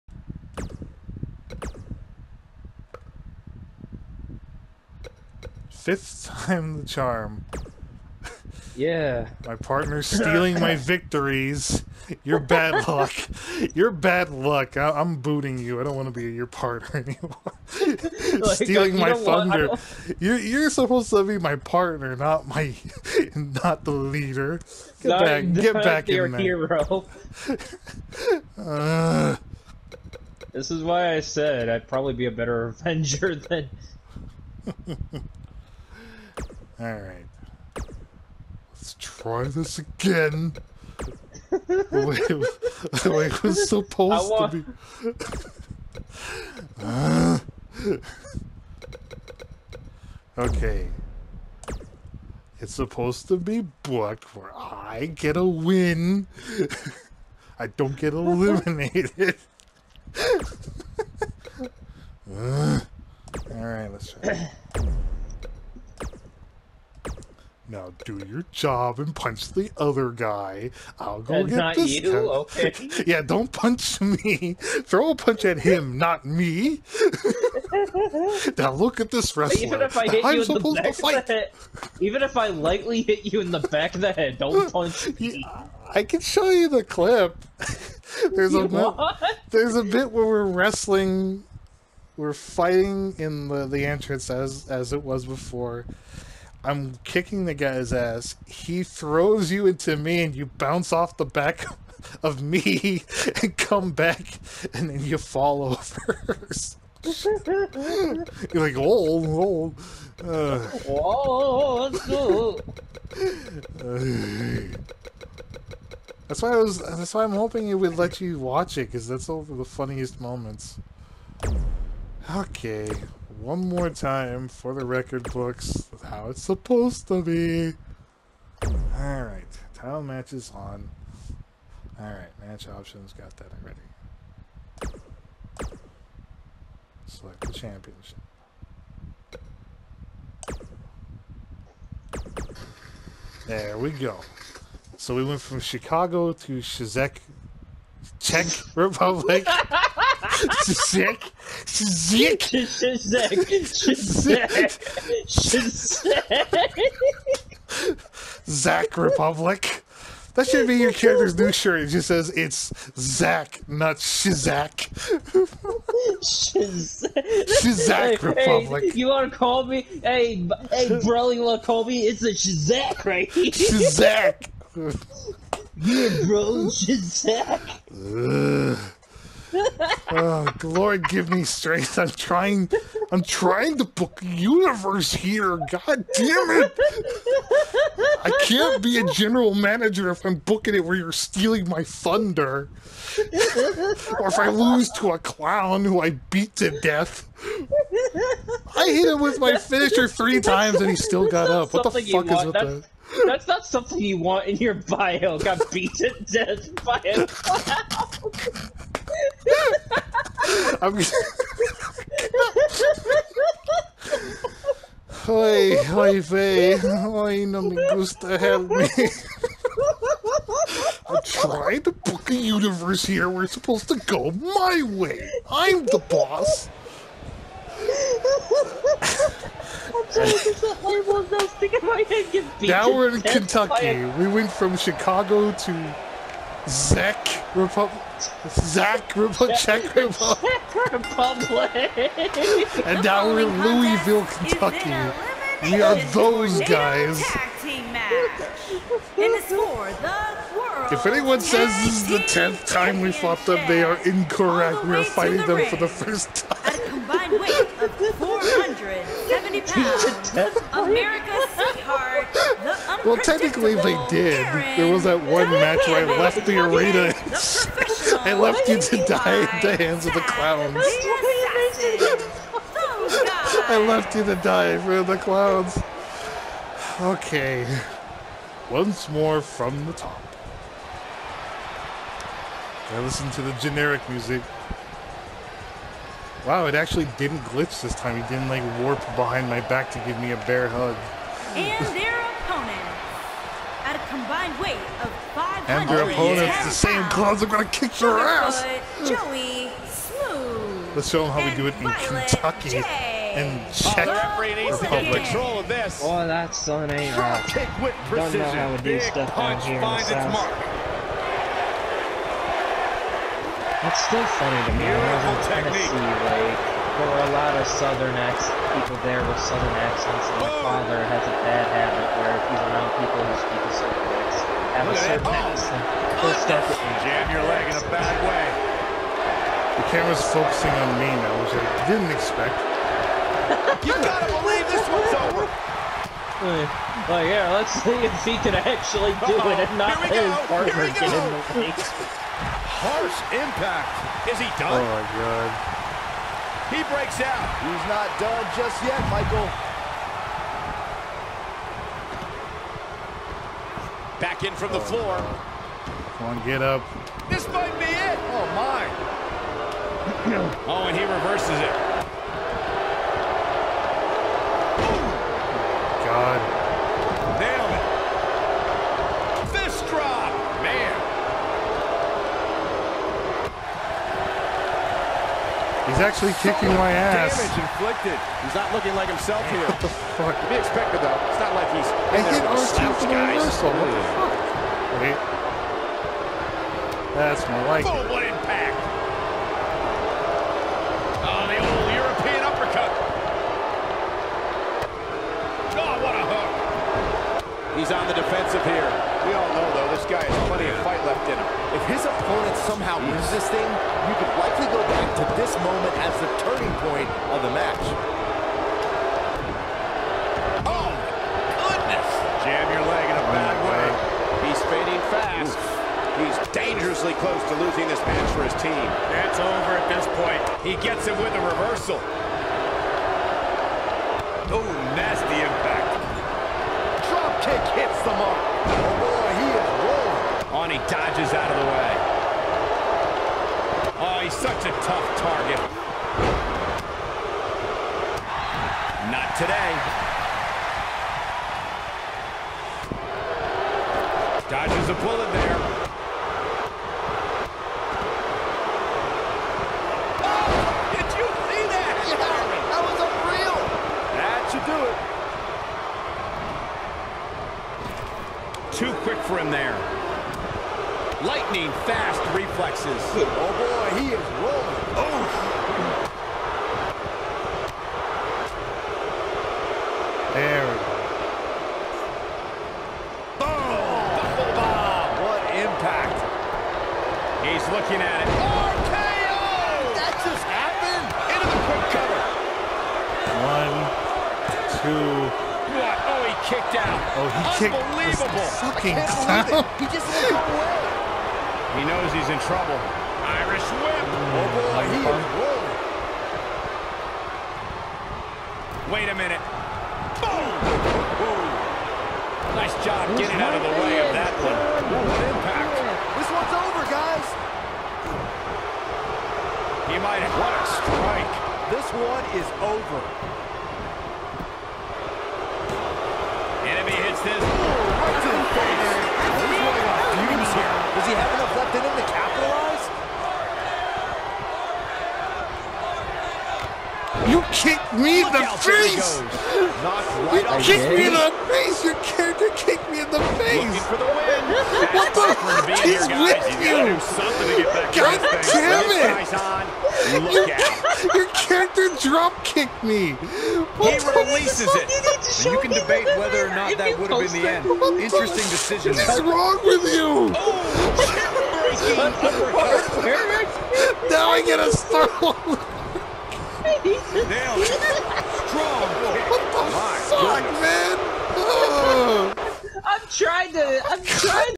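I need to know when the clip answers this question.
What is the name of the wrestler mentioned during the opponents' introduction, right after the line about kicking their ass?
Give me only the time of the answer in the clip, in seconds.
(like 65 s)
299 s.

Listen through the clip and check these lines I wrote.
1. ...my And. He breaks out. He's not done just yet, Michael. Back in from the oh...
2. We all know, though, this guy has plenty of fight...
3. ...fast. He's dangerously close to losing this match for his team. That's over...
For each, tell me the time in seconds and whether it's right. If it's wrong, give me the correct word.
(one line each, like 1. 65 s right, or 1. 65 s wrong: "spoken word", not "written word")
1. 344 s wrong: "God", not "And"
2. 399 s right
3. 415 s right.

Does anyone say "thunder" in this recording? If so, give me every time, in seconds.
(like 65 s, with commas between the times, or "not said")
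19 s, 191 s.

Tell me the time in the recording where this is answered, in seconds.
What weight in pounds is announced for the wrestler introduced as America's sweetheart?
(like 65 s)
258 s.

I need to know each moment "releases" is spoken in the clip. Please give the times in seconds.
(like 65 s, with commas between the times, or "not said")
544 s.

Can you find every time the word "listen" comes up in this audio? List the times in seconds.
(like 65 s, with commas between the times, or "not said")
282 s.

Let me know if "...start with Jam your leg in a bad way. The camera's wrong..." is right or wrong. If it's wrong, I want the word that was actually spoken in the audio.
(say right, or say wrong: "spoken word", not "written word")
wrong: "focusing", not "wrong".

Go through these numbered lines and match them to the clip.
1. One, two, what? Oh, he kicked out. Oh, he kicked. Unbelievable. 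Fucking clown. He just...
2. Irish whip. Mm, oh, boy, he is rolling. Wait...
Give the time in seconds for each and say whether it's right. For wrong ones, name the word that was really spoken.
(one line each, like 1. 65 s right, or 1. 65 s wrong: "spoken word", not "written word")
1. 483 s right
2. 493 s right.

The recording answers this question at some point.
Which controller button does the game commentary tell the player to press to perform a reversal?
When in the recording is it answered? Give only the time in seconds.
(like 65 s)
382 s.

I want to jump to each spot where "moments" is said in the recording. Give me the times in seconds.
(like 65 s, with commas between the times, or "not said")
120 s, 405 s.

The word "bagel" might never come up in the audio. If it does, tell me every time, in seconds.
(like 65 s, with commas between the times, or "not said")
not said.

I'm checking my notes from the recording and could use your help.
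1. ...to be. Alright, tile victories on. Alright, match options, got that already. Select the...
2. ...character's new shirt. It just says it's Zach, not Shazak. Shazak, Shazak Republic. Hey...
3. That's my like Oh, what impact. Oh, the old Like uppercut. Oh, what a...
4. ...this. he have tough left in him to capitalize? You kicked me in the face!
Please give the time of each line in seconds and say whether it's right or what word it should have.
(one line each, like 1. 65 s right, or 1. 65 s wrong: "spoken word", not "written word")
1. 127 s wrong: "matches", not "victories"
2. 160 s right
3. 387 s wrong: "European", not "Like"
4. 517 s wrong: "enough", not "tough".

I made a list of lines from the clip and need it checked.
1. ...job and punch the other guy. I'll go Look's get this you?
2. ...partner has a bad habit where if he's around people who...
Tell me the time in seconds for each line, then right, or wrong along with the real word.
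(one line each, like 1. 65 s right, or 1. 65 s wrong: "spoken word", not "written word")
1. 68 s wrong: "That", not "Look"
2. 320 s wrong: "father", not "partner".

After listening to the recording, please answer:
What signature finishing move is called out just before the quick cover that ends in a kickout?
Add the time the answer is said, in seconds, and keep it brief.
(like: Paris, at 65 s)
RKO, at 478 s.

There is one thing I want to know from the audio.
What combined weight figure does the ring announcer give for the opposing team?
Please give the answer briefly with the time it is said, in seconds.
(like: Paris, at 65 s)
500, at 295 s.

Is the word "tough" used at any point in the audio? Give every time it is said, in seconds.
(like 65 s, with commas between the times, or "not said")
434 s.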